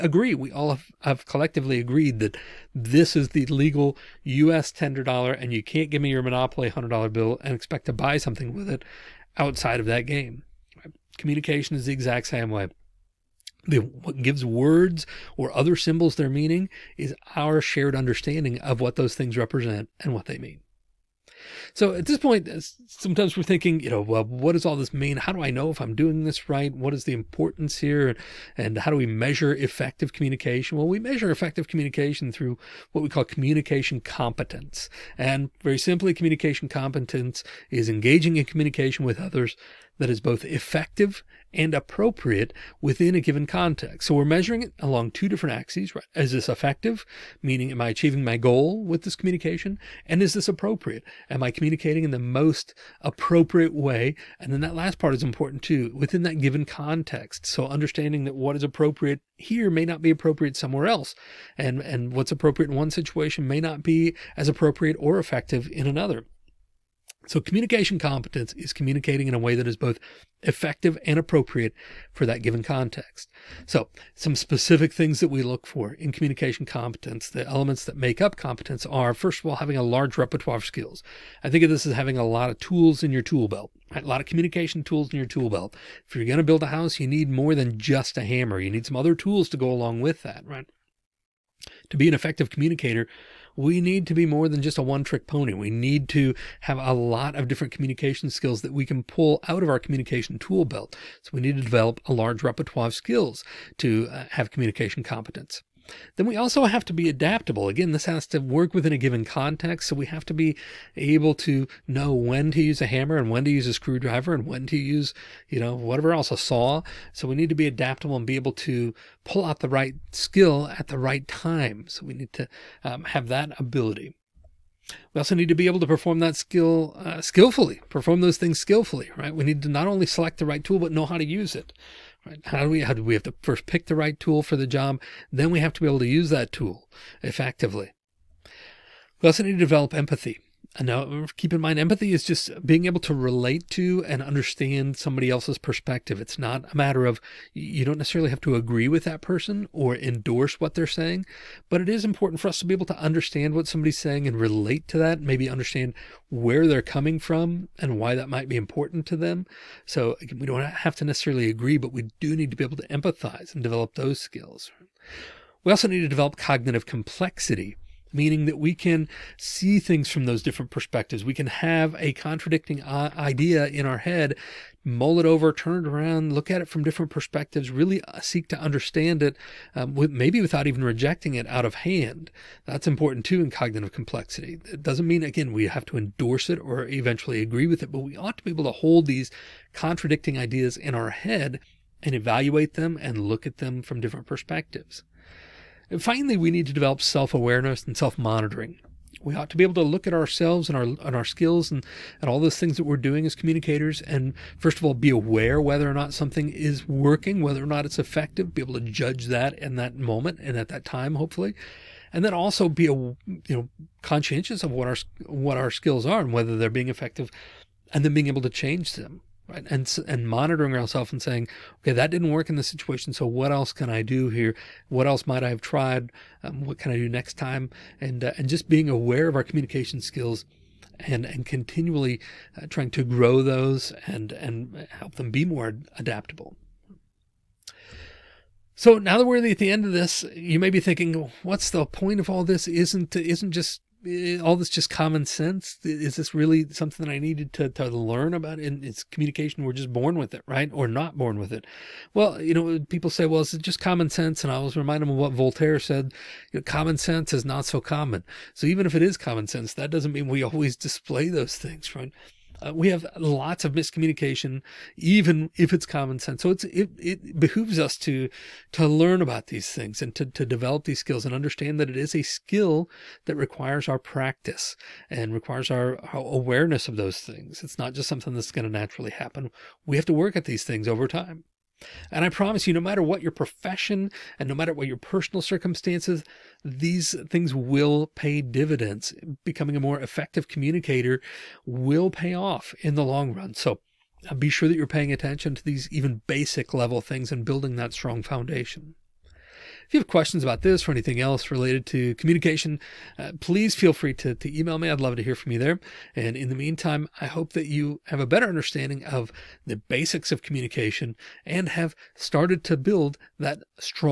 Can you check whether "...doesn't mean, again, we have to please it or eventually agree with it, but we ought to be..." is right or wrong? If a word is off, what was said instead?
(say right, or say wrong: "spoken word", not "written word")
wrong: "endorse", not "please".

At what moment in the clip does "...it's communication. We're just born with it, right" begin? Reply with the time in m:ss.
4:08.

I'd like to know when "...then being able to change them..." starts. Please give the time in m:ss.
3:38.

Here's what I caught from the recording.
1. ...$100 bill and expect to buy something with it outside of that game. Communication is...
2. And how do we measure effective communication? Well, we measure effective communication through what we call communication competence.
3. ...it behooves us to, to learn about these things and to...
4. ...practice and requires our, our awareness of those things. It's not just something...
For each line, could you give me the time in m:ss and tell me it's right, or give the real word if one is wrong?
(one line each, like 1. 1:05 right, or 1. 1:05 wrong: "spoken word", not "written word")
1. 0:06 right
2. 0:28 right
3. 4:26 right
4. 4:33 right.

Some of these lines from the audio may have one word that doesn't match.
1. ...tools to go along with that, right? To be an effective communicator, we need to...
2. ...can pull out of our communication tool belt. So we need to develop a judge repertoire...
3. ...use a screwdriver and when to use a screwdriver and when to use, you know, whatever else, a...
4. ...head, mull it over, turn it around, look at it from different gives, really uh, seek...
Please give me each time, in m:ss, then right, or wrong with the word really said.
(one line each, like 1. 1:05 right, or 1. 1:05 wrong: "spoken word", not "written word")
1. 1:29 right
2. 1:38 wrong: "large", not "judge"
3. 1:52 wrong: "hammer", not "screwdriver"
4. 2:53 wrong: "perspectives", not "gives".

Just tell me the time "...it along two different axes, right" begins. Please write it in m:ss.
0:44.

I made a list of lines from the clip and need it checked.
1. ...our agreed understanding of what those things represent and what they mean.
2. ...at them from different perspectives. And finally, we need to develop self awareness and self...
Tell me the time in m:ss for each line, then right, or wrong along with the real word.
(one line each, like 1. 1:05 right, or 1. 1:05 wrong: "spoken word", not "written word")
1. 0:17 wrong: "shared", not "agreed"
2. 3:13 right.